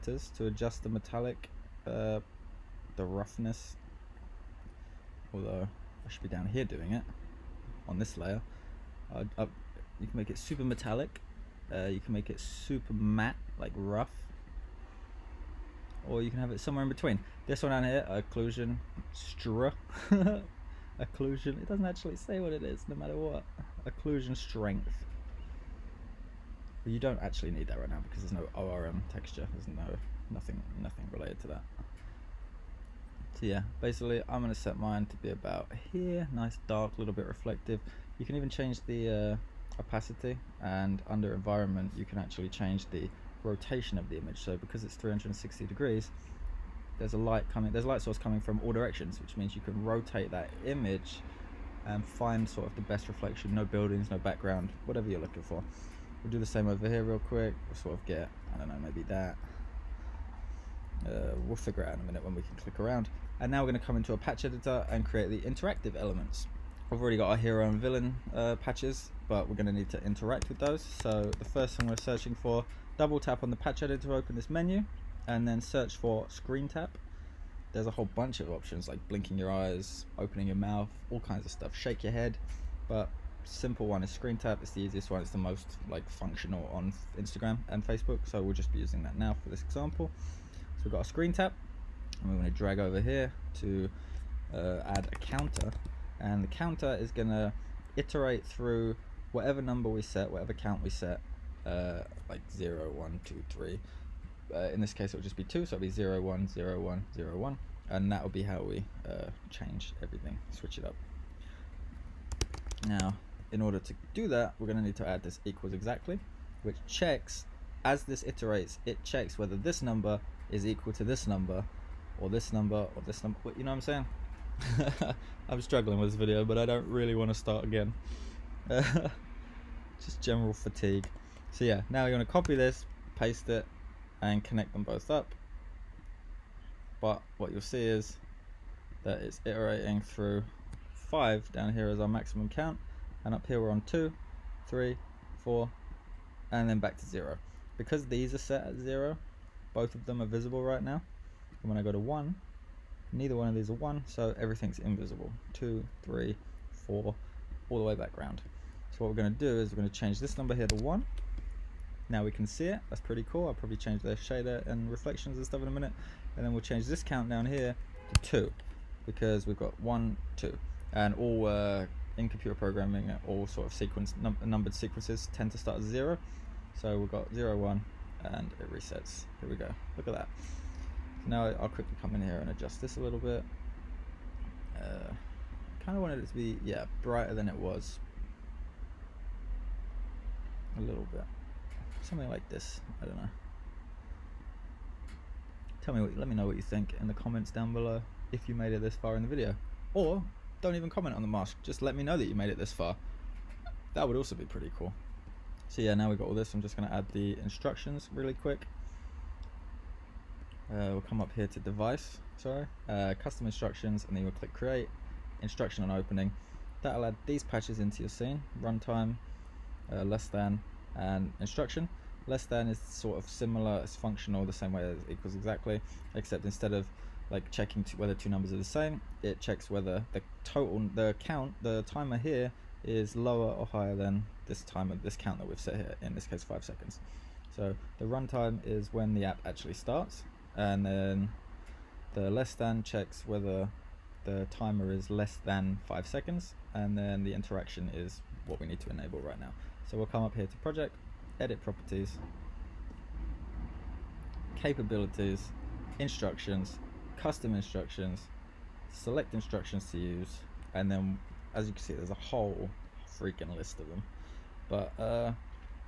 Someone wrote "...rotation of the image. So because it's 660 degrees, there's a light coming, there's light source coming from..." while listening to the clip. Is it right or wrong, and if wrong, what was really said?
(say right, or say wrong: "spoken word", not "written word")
wrong: "360", not "660".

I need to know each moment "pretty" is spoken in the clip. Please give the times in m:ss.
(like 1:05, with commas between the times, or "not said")
2:43, 3:24.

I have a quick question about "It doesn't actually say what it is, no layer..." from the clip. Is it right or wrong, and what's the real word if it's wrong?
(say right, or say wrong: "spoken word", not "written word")
wrong: "matter", not "layer".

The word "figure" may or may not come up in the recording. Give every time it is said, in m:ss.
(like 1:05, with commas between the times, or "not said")
1:01.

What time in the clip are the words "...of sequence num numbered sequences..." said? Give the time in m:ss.
2:53.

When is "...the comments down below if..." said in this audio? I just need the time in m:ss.
3:17.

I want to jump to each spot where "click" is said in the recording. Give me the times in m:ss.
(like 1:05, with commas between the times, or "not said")
1:02, 3:34.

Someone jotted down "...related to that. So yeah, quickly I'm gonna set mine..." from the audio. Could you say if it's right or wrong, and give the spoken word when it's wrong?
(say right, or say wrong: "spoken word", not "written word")
wrong: "basically", not "quickly".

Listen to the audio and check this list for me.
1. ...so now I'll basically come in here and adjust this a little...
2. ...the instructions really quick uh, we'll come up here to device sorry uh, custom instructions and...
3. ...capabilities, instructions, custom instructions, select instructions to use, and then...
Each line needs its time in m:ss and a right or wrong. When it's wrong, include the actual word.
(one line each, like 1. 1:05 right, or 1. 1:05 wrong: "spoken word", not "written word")
1. 3:00 wrong: "quickly", not "basically"
2. 3:27 right
3. 4:14 right.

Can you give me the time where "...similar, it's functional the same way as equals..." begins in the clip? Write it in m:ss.
3:43.